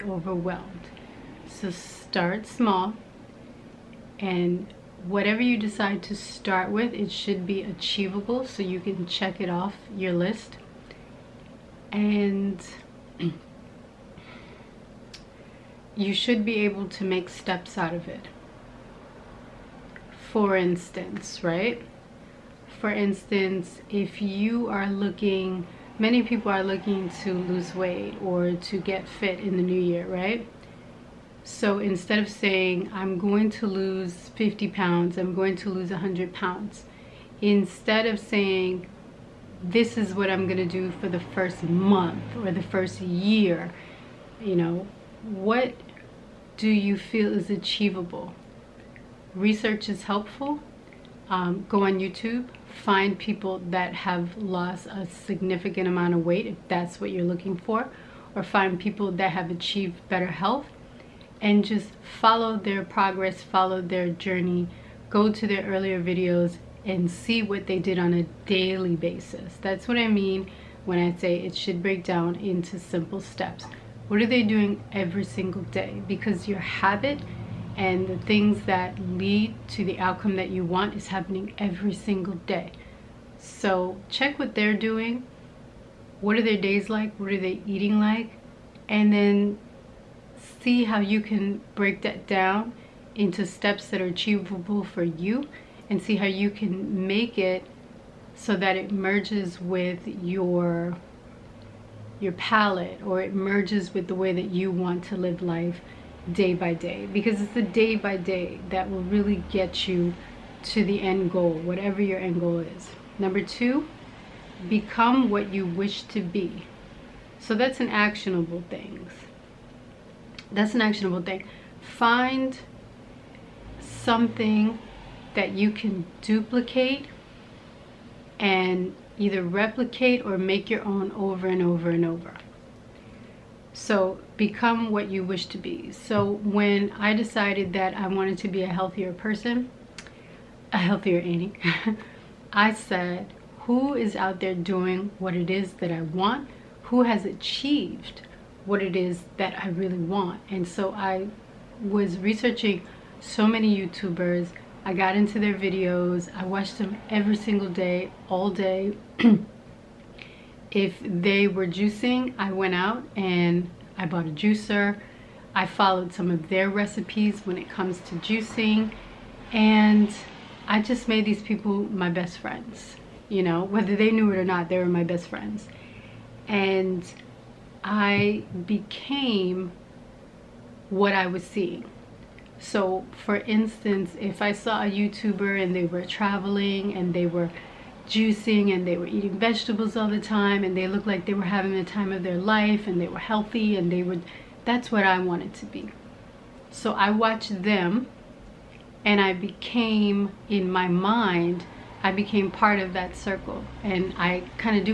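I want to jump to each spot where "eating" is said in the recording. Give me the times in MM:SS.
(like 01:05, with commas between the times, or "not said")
01:27, 03:09.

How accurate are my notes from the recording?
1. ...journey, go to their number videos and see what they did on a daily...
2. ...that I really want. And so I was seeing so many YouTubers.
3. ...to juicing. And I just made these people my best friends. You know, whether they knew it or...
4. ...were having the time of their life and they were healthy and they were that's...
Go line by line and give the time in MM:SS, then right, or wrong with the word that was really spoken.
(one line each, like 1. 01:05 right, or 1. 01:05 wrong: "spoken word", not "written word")
1. 01:04 wrong: "earlier", not "number"
2. 02:29 wrong: "researching", not "seeing"
3. 02:48 right
4. 03:11 right.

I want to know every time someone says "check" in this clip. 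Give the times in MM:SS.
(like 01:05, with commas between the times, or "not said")
00:09, 01:24.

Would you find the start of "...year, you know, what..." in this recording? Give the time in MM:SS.
00:43.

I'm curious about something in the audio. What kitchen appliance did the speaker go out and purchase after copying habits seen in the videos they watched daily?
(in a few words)
Juicer.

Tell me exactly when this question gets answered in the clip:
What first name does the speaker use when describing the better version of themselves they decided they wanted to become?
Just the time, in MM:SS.
02:21.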